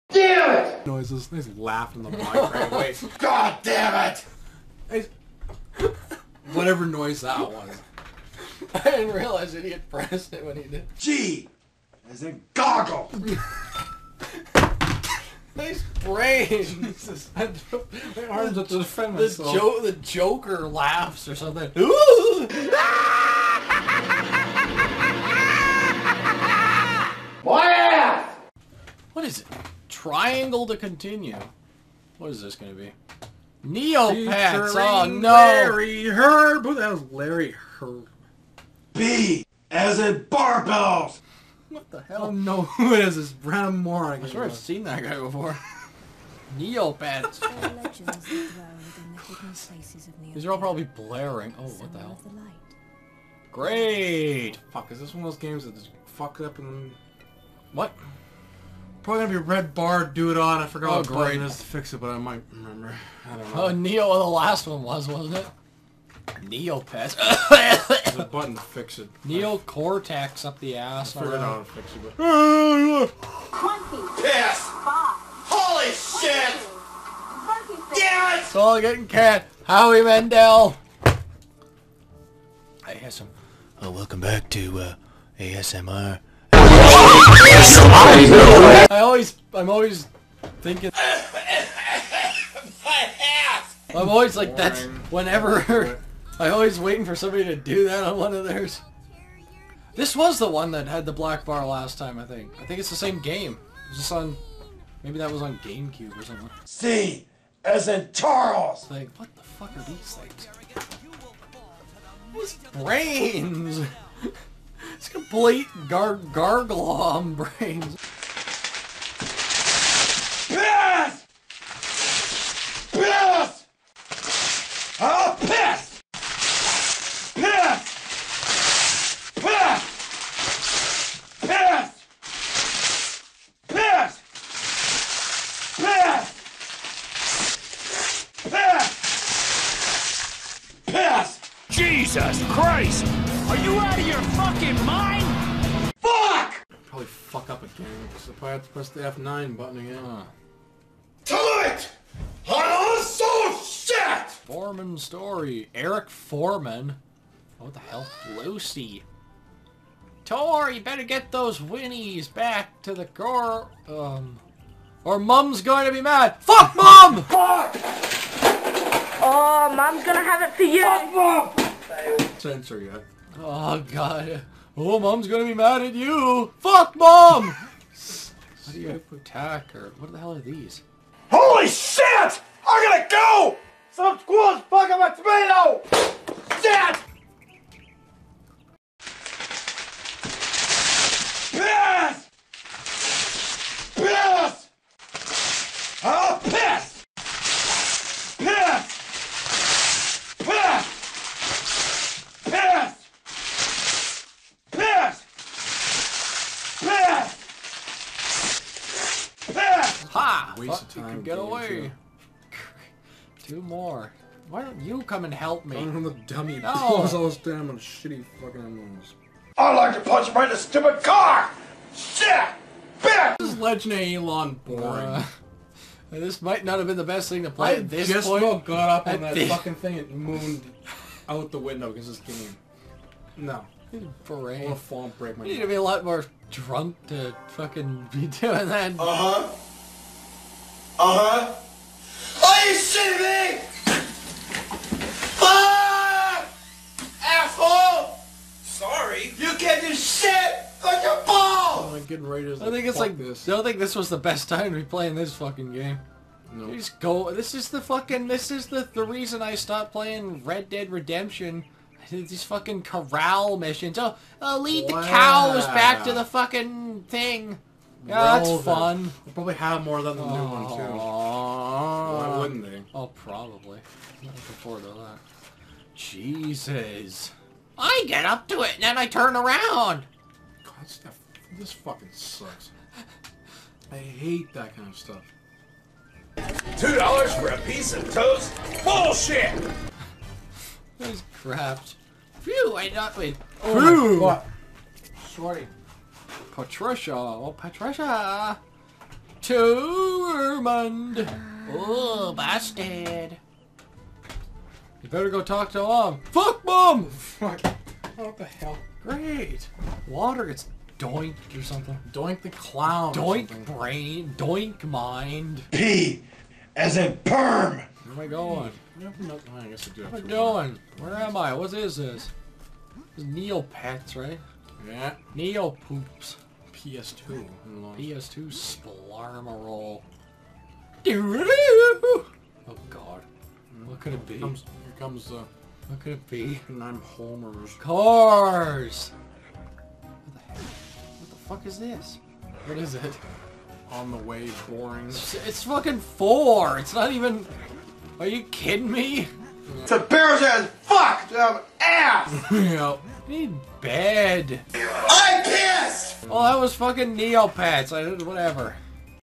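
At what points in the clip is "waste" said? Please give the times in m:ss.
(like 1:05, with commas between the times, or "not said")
3:30.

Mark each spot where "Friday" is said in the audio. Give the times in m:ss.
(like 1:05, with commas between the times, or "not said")
not said.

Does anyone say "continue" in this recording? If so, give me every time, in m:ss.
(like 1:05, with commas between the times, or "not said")
0:30.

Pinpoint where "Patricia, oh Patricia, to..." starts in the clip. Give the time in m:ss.
4:56.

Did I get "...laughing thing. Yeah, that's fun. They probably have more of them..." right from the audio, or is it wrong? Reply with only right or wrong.
wrong.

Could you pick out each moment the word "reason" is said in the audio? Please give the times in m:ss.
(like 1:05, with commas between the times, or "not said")
4:19.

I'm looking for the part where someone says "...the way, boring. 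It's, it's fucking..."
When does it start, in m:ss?
5:44.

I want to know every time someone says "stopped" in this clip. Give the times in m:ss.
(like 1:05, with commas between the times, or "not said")
4:19.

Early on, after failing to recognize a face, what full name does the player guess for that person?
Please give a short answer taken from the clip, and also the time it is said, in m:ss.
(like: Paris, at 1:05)
Brandon Moran, at 0:43.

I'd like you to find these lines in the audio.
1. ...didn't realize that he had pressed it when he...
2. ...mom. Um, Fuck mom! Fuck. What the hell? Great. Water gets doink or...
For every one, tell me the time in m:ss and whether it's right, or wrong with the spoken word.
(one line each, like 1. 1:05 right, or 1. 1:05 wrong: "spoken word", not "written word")
1. 0:08 right
2. 5:05 right.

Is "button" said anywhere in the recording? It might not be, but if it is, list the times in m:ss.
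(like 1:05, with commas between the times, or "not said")
1:01, 1:08, 2:29.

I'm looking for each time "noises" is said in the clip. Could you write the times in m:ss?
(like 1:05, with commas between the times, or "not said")
0:00, 0:06.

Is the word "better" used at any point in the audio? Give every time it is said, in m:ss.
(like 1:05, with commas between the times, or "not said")
2:40, 5:05.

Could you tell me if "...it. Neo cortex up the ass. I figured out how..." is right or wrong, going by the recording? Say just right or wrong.
right.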